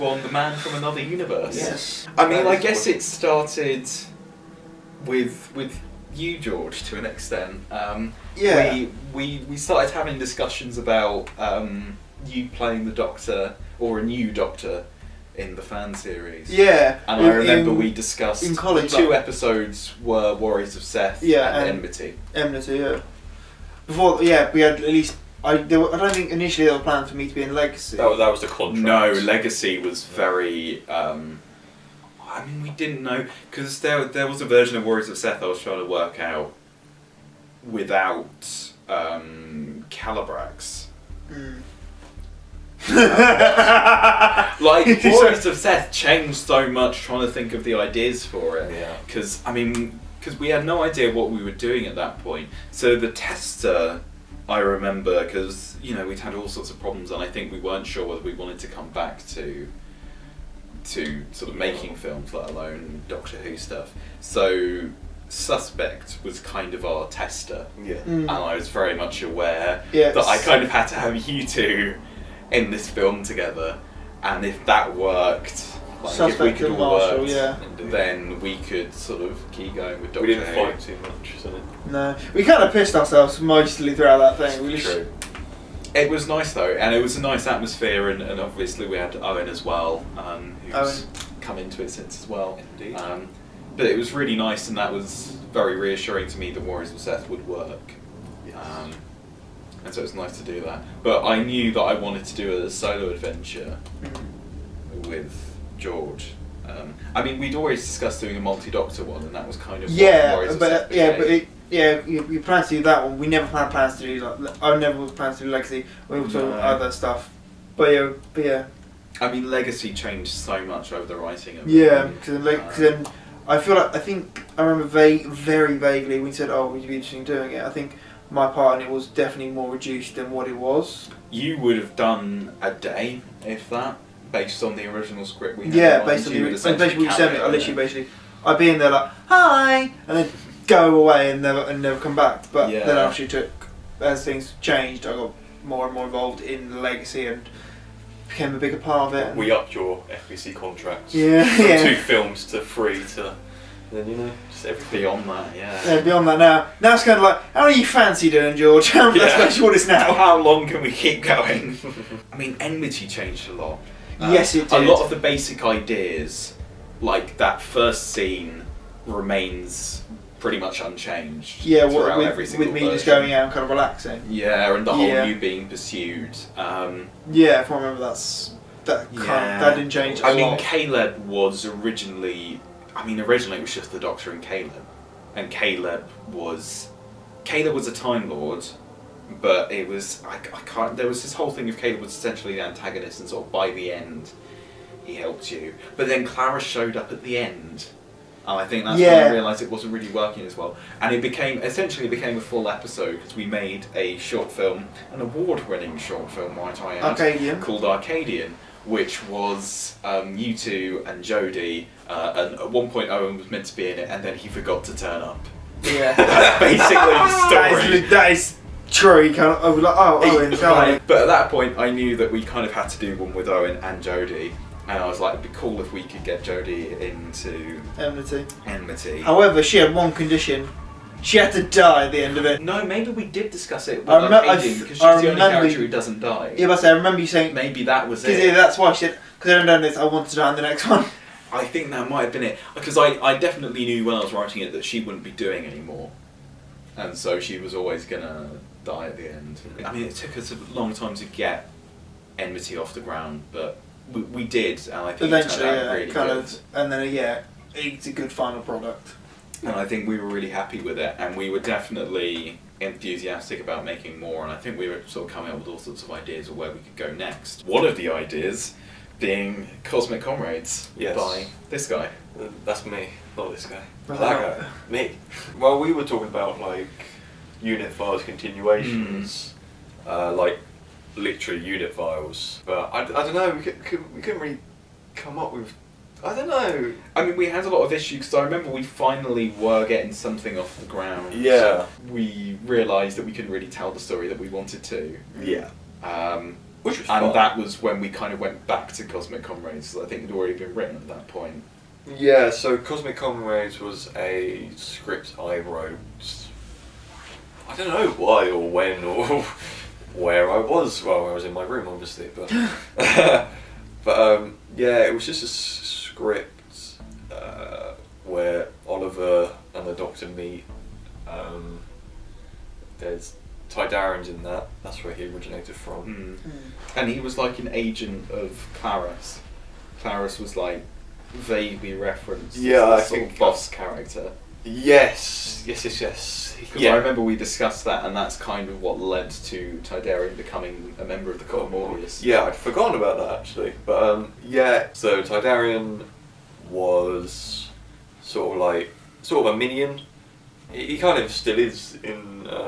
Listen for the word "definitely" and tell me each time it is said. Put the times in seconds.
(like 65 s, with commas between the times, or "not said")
129 s, 243 s, 261 s.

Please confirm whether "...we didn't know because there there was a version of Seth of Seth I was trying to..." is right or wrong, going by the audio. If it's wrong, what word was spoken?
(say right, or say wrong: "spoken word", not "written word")
wrong: "Warriors", not "Seth".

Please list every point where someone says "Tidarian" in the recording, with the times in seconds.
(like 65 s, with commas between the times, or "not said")
323 s, 339 s, 345 s.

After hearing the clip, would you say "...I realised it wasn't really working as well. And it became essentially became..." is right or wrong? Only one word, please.
right.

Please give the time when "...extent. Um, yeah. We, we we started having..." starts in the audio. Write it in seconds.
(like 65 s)
7 s.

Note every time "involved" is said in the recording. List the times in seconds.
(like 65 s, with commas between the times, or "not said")
146 s.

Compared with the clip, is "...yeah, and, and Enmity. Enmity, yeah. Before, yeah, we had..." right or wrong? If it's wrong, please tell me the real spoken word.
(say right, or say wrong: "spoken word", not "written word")
right.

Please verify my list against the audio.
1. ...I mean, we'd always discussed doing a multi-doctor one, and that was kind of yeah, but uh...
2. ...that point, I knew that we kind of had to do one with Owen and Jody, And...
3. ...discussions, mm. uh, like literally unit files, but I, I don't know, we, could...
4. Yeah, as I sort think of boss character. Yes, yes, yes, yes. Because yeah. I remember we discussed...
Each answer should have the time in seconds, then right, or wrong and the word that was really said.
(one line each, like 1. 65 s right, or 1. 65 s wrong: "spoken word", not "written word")
1. 107 s right
2. 221 s right
3. 278 s wrong: "continuations", not "discussions"
4. 332 s right.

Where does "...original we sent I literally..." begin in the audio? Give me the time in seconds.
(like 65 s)
136 s.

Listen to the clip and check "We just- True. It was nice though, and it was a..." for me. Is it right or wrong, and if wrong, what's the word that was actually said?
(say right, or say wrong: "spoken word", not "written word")
right.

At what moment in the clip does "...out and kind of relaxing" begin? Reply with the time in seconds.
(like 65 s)
173 s.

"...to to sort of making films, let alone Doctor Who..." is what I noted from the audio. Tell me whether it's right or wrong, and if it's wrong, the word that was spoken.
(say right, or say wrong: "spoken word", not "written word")
right.